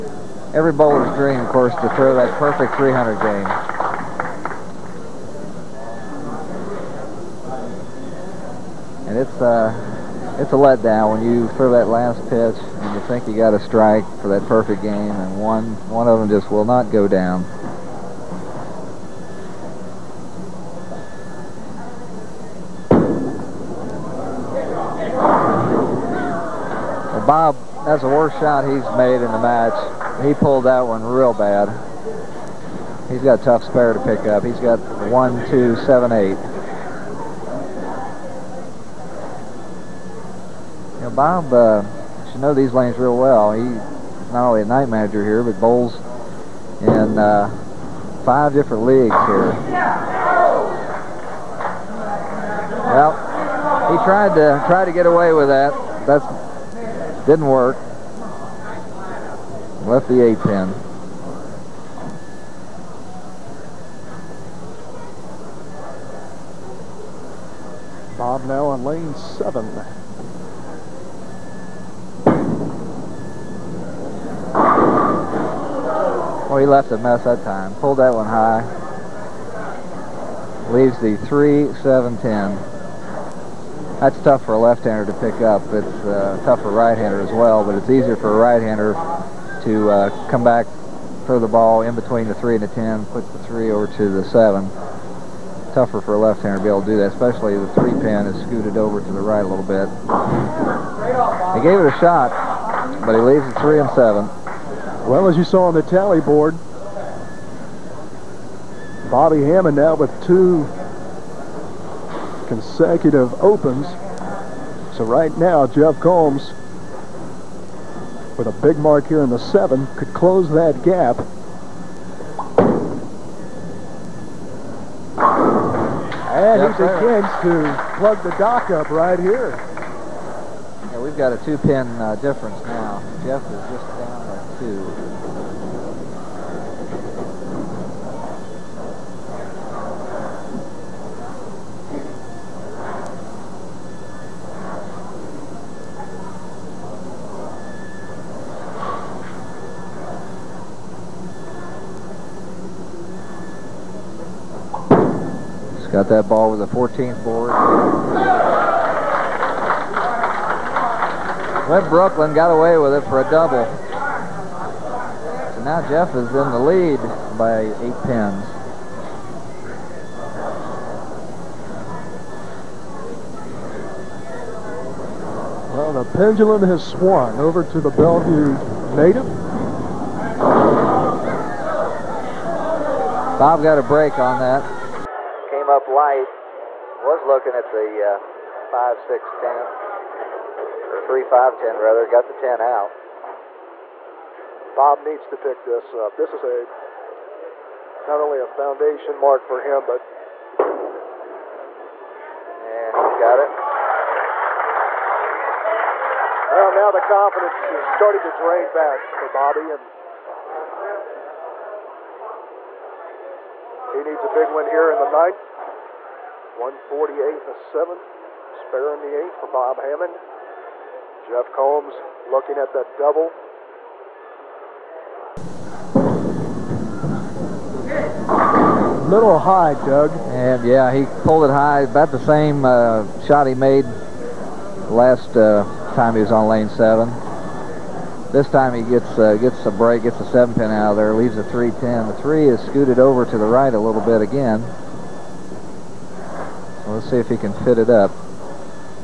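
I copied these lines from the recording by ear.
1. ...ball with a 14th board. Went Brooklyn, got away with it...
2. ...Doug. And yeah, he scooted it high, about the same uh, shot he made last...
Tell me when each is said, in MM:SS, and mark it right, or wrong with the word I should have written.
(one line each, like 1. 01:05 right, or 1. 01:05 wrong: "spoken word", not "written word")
1. 02:36 right
2. 03:49 wrong: "pulled", not "scooted".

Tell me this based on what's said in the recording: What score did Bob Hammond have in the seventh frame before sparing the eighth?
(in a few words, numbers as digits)
148.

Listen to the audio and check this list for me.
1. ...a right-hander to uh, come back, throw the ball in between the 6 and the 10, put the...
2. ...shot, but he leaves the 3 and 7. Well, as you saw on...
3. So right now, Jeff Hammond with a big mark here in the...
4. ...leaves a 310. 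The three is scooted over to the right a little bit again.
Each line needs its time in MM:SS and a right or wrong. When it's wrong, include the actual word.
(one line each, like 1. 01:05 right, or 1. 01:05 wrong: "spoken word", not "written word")
1. 01:28 wrong: "3", not "6"
2. 01:41 right
3. 01:54 wrong: "Combs", not "Hammond"
4. 04:01 right.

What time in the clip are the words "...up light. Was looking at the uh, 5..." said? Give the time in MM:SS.
03:05.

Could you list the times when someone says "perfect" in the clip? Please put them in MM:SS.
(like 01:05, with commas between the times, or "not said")
00:02, 00:14.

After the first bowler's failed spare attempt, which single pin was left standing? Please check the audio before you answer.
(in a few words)
8 pin.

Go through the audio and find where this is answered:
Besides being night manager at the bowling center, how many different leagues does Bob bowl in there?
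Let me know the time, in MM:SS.
00:48.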